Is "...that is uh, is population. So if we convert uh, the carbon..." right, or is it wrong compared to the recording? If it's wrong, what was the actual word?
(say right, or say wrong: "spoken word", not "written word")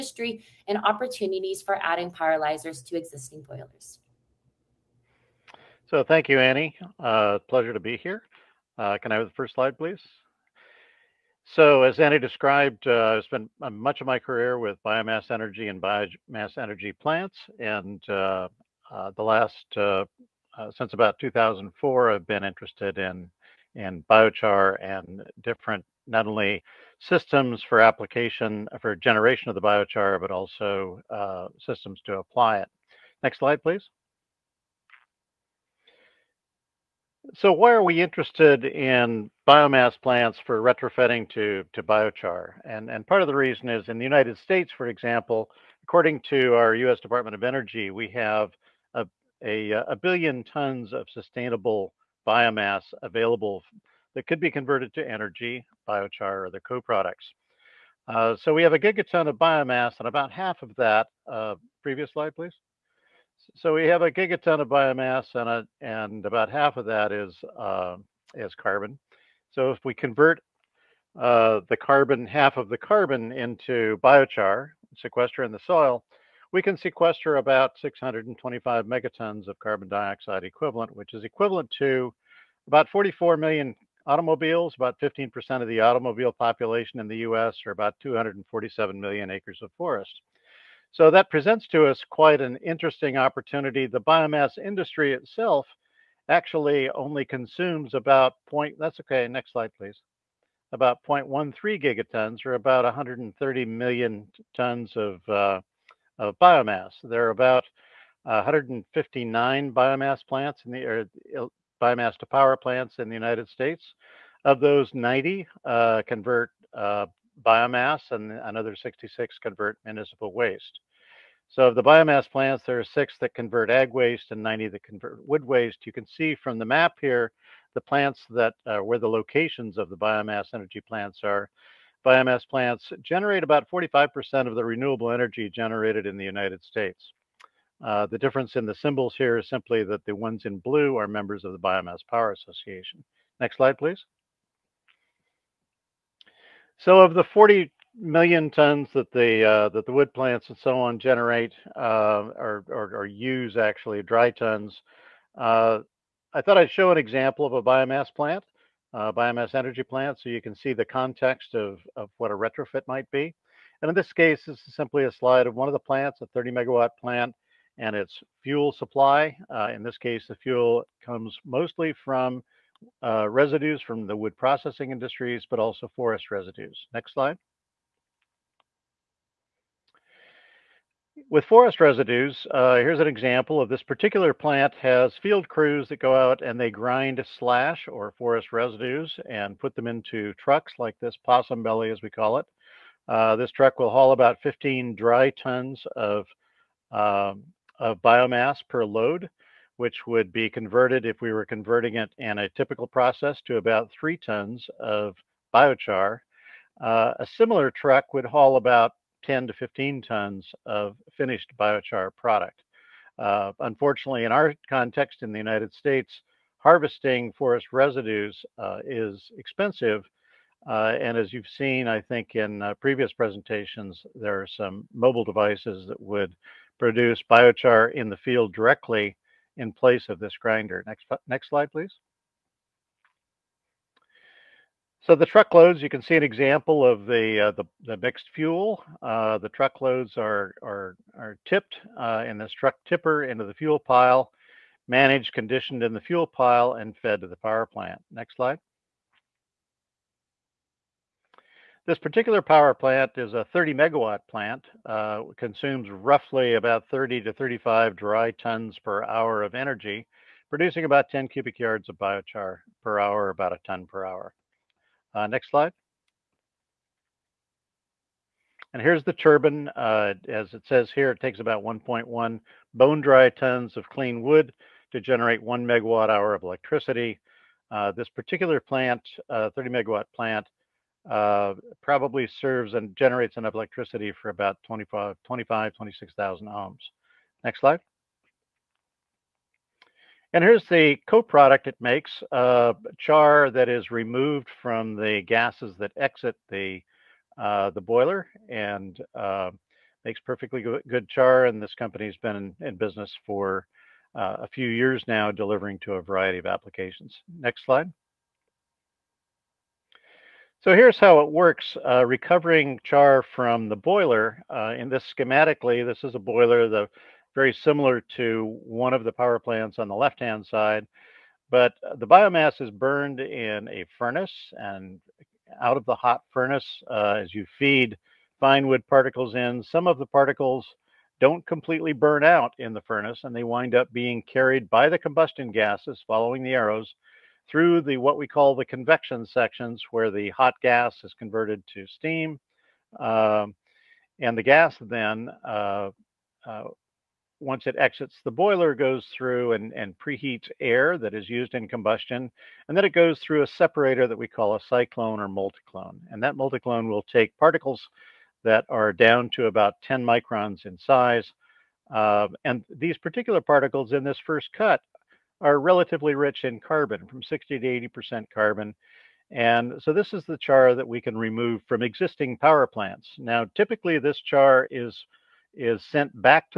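wrong: "carbon", not "population".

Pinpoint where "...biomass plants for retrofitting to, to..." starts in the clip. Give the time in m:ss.
0:39.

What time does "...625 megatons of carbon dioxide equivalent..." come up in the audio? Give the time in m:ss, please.
1:17.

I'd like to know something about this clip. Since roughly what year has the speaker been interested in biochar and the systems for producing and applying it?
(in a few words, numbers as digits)
2004.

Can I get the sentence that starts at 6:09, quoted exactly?
And so this is the char that we can remove from existing power plants.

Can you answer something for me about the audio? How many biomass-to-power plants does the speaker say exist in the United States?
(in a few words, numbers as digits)
159.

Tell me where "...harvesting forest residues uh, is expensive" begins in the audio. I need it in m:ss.
3:36.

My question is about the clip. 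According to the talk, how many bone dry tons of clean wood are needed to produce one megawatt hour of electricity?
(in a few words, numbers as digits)
1.1.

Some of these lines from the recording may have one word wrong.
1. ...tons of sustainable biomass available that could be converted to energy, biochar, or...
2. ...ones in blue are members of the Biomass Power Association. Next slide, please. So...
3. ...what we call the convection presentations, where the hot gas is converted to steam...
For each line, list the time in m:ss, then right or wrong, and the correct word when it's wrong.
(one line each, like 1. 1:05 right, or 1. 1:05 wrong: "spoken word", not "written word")
1. 0:50 right
2. 2:20 right
3. 5:37 wrong: "sections", not "presentations".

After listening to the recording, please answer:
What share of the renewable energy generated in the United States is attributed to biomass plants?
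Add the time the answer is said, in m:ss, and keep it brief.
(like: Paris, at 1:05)
45%, at 2:13.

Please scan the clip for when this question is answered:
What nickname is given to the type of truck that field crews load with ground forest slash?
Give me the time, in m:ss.
3:11.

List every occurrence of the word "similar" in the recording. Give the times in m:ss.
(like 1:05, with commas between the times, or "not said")
3:27, 5:17.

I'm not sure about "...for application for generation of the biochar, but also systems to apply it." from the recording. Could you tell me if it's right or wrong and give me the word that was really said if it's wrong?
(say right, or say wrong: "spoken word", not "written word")
right.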